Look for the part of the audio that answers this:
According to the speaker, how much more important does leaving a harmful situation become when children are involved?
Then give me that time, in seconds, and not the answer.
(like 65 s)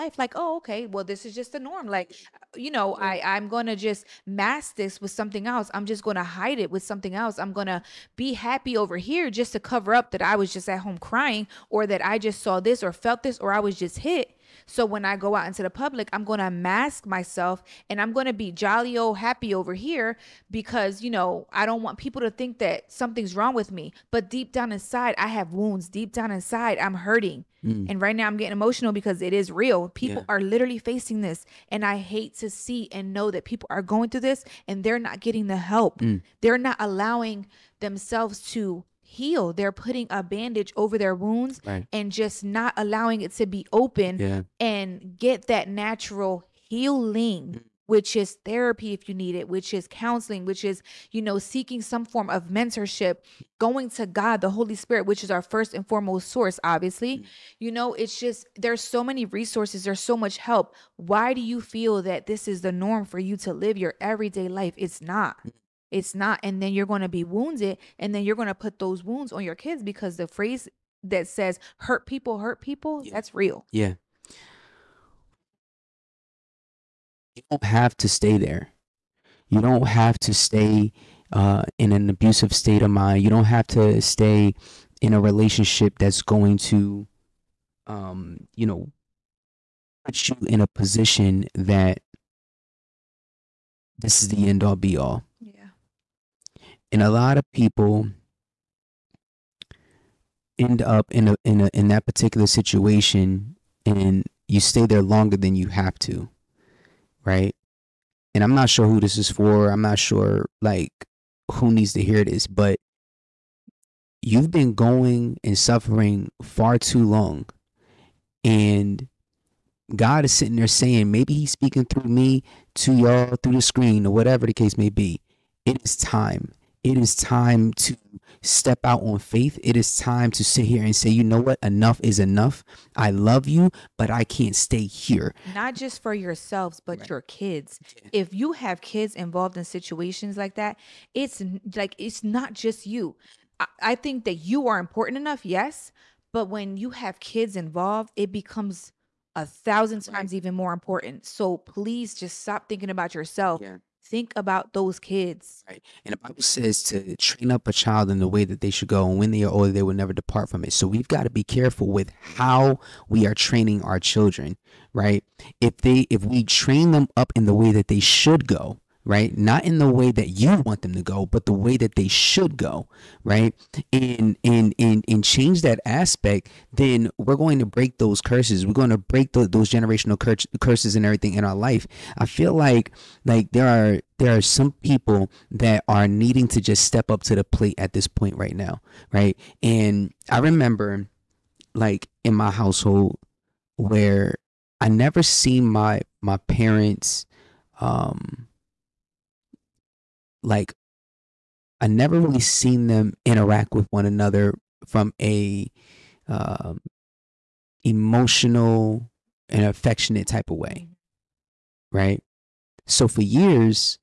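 149 s.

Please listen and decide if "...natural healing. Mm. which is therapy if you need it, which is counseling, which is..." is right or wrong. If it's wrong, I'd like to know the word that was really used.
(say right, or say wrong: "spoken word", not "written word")
right.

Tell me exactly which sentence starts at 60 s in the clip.
Why do you feel that this is the norm for you to live your everyday life?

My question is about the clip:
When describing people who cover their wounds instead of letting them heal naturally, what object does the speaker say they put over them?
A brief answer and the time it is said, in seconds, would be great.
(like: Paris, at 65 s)
a bandage, at 40 s.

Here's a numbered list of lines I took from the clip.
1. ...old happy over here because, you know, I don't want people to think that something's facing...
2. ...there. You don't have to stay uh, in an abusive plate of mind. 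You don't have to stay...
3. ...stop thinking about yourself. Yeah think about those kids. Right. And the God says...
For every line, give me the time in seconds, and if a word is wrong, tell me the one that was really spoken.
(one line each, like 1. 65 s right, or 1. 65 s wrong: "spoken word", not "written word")
1. 18 s wrong: "wrong", not "facing"
2. 78 s wrong: "state", not "plate"
3. 152 s wrong: "Bible", not "God".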